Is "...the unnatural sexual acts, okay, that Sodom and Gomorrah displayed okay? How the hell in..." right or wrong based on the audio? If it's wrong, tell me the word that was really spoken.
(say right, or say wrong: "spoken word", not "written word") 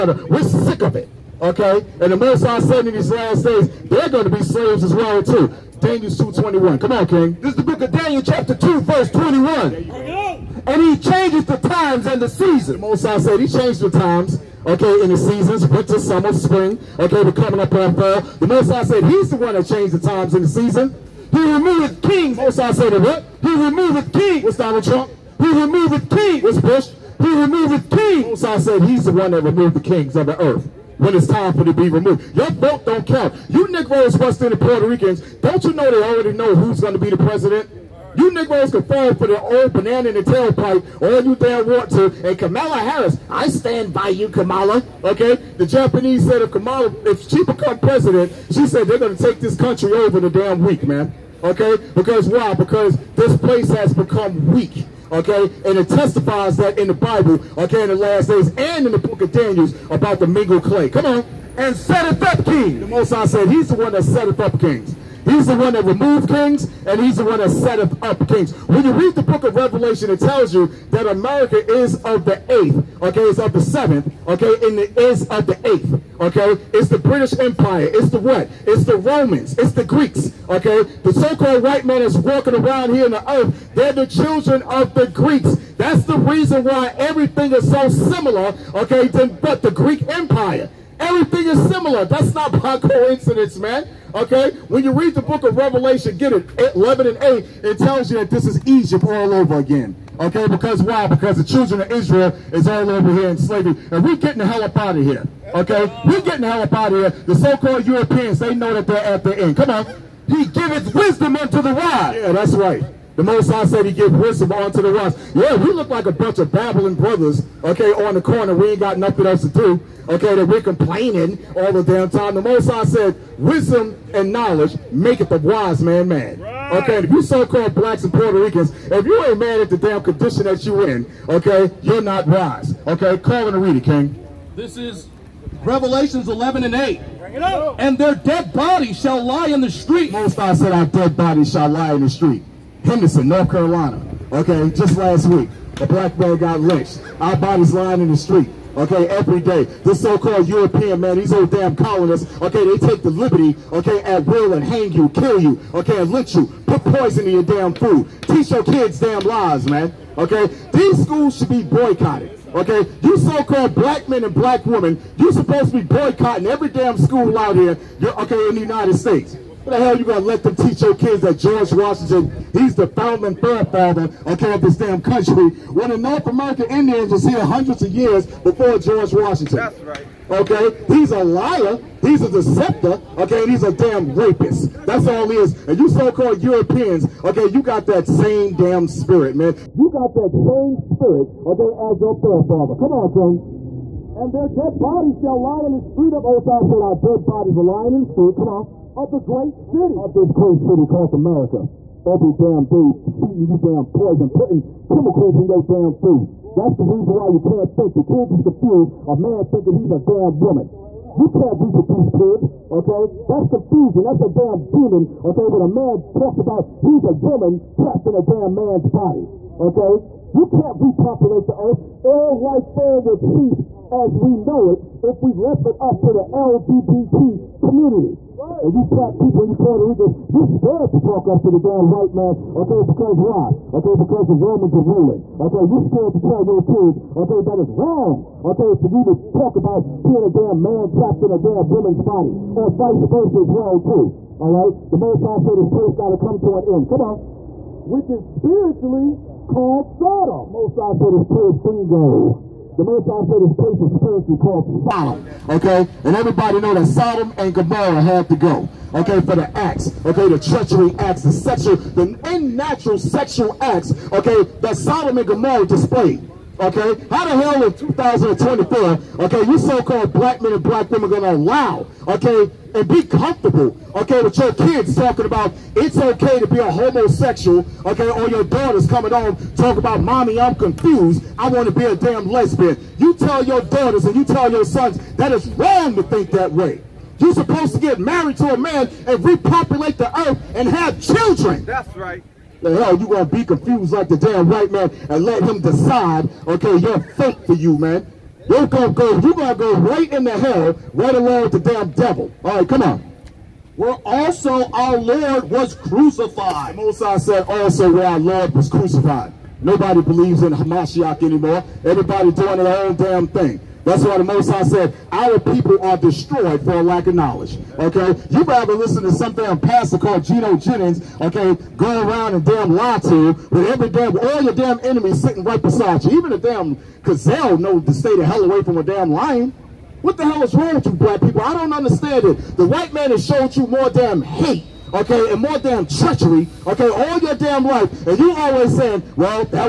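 right.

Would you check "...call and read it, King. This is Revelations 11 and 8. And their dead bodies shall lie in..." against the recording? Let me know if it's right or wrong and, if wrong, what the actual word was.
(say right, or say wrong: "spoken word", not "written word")
right.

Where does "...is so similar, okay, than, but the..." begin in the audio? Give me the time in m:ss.
1:27.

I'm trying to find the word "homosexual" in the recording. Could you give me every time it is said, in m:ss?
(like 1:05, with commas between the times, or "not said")
4:36.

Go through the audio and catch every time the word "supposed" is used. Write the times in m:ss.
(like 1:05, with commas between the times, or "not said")
2:45, 4:47.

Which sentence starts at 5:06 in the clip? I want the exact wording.
Mosai said also where our Lord was crucified.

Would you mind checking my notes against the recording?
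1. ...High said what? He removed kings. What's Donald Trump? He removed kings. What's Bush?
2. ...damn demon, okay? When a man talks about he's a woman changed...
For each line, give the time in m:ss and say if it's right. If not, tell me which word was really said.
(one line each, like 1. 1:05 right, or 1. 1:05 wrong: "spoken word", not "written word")
1. 0:22 right
2. 3:34 wrong: "trapped", not "changed".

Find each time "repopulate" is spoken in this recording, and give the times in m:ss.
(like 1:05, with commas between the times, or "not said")
3:40, 4:49.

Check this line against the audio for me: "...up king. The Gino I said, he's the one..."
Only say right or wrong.
wrong.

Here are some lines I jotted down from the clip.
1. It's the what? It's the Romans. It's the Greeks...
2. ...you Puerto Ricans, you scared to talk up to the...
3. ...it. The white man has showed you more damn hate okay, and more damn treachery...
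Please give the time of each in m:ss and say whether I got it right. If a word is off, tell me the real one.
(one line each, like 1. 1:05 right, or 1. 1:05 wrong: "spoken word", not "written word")
1. 1:17 right
2. 3:49 right
3. 5:32 right.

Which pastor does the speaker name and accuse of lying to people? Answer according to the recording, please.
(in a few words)
Gino Jennings.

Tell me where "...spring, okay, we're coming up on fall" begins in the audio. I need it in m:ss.
0:16.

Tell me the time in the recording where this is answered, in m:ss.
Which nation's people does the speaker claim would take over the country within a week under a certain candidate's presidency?
0:45.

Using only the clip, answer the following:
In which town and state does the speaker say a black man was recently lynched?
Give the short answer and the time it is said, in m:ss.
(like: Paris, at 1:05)
Henderson, North Carolina, at 2:22.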